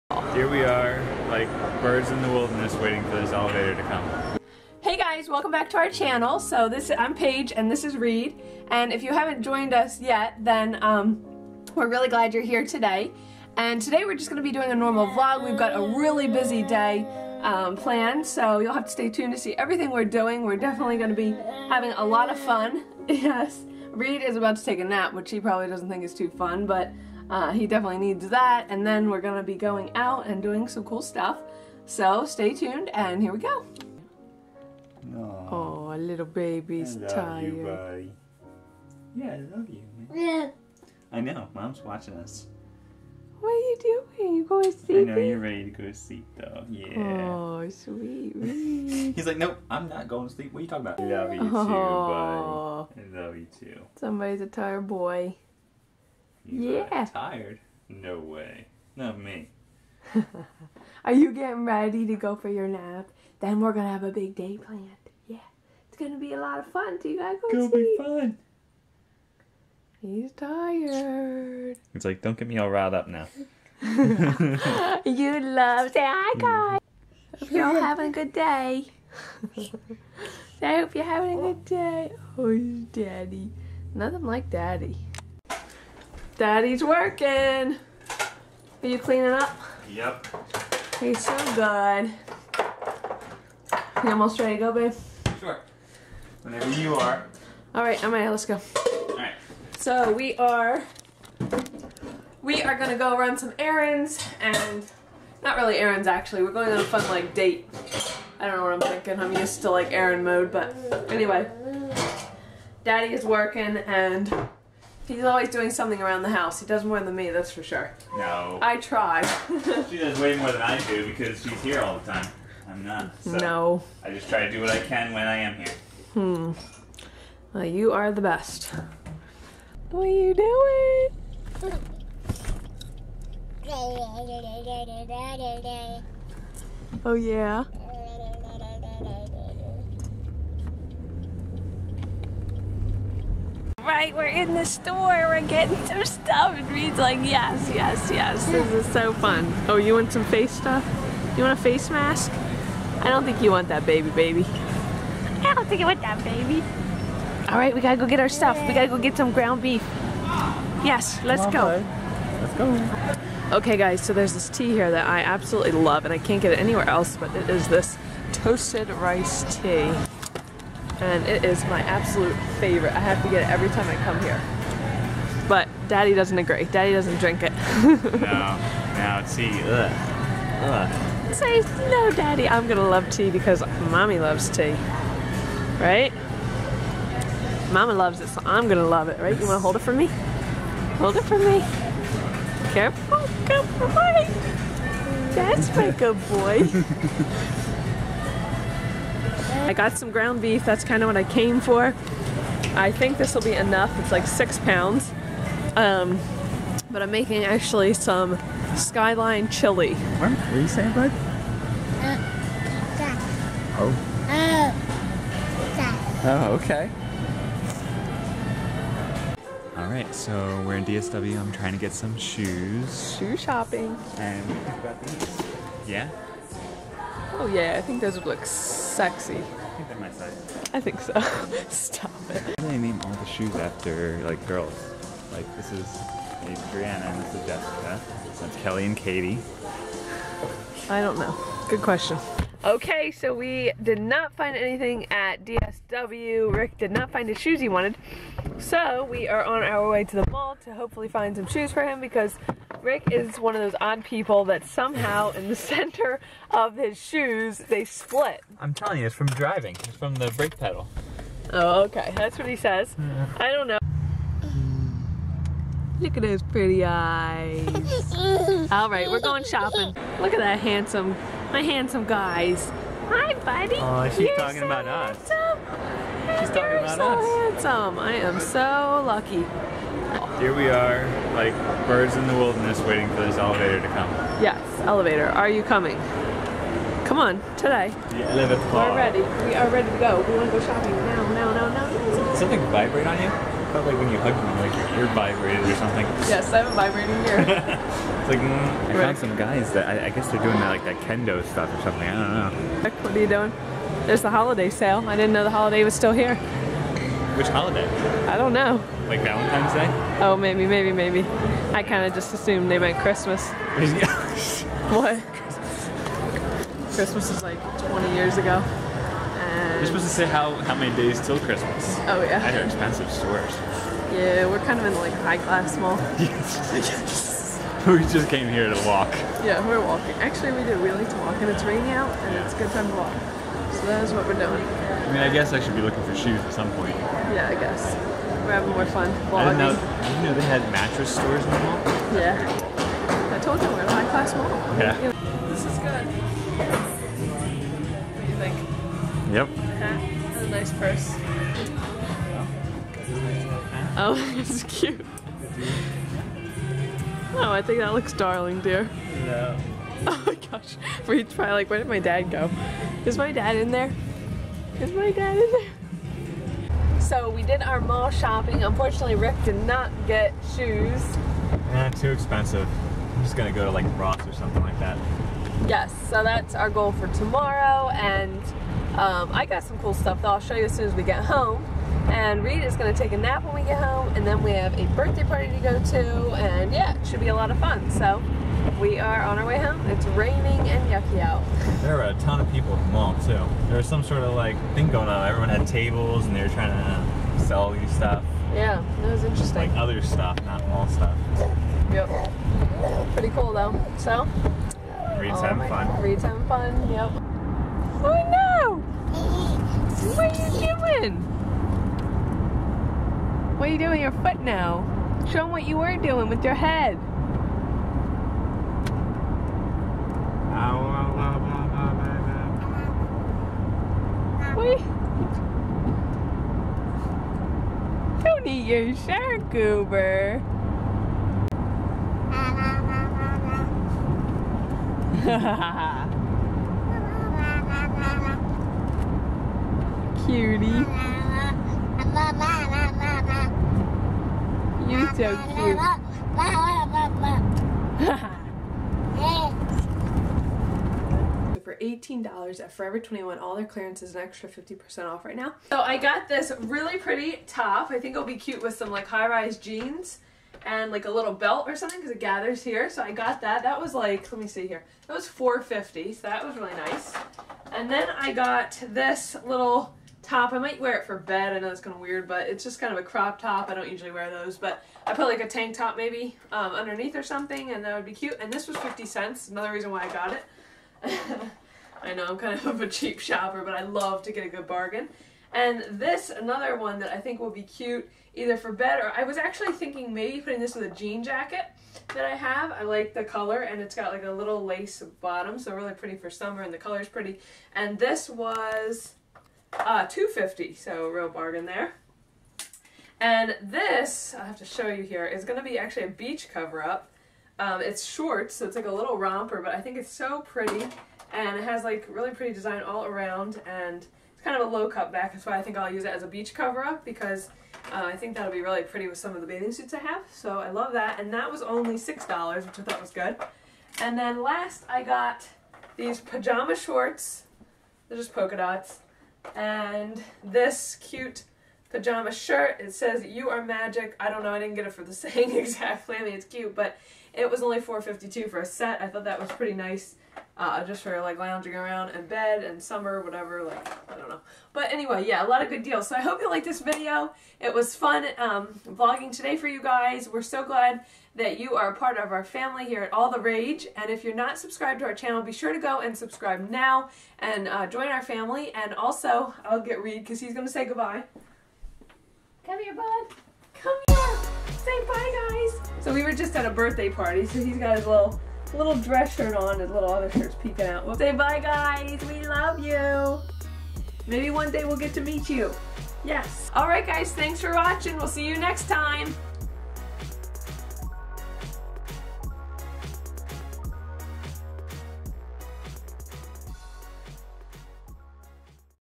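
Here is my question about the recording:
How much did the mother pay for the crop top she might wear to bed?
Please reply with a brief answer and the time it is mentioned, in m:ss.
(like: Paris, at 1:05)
50 cents, at 7:58.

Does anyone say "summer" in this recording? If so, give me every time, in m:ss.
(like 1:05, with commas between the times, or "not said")
8:16, 9:02.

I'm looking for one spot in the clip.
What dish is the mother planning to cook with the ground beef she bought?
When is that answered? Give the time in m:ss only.
3:28.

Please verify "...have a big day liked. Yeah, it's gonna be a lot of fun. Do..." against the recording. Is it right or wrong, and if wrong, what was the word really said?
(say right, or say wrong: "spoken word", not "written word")
wrong: "planned", not "liked".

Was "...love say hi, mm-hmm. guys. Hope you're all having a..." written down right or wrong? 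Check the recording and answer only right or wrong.
right.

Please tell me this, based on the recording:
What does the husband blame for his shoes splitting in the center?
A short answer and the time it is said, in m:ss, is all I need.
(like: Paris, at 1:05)
The brake pedal, at 4:20.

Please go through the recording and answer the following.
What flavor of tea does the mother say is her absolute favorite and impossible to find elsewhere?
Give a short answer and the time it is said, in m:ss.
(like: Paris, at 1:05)
Toasted rice tea, at 2:48.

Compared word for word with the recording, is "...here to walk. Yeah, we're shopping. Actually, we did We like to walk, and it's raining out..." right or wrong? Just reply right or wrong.
wrong.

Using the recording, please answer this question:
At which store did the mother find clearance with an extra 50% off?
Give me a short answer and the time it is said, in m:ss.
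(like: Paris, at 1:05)
Forever 21, at 7:32.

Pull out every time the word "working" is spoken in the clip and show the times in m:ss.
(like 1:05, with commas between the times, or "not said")
1:26, 1:53.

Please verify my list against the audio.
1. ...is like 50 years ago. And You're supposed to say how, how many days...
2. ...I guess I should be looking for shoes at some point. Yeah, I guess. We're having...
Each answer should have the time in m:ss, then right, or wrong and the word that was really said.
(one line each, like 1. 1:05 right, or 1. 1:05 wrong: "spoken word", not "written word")
1. 5:17 wrong: "20", not "50"
2. 5:35 right.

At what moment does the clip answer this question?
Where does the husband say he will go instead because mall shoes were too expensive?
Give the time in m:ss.
6:13.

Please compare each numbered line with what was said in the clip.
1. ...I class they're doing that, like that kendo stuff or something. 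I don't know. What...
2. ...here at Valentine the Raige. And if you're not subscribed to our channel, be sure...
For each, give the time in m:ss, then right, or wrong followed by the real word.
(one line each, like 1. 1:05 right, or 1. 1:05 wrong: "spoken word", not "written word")
1. 5:00 wrong: "guess", not "class"
2. 9:12 wrong: "All", not "Valentine".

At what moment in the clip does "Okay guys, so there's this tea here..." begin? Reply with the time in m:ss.
2:43.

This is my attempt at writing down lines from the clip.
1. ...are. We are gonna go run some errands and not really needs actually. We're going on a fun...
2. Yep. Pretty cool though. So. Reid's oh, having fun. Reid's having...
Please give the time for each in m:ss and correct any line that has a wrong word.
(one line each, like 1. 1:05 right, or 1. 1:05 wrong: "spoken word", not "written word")
1. 1:40 wrong: "errands", not "needs"
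2. 6:41 right.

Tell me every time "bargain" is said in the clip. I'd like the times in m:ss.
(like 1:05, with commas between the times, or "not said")
8:04, 8:21.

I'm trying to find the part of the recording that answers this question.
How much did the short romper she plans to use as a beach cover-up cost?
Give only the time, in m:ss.
8:41.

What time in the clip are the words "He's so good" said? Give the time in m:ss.
1:30.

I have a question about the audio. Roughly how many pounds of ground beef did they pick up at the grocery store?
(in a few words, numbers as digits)
6 pounds.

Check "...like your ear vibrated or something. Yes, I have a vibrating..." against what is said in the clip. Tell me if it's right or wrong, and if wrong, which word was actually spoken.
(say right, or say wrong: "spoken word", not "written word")
right.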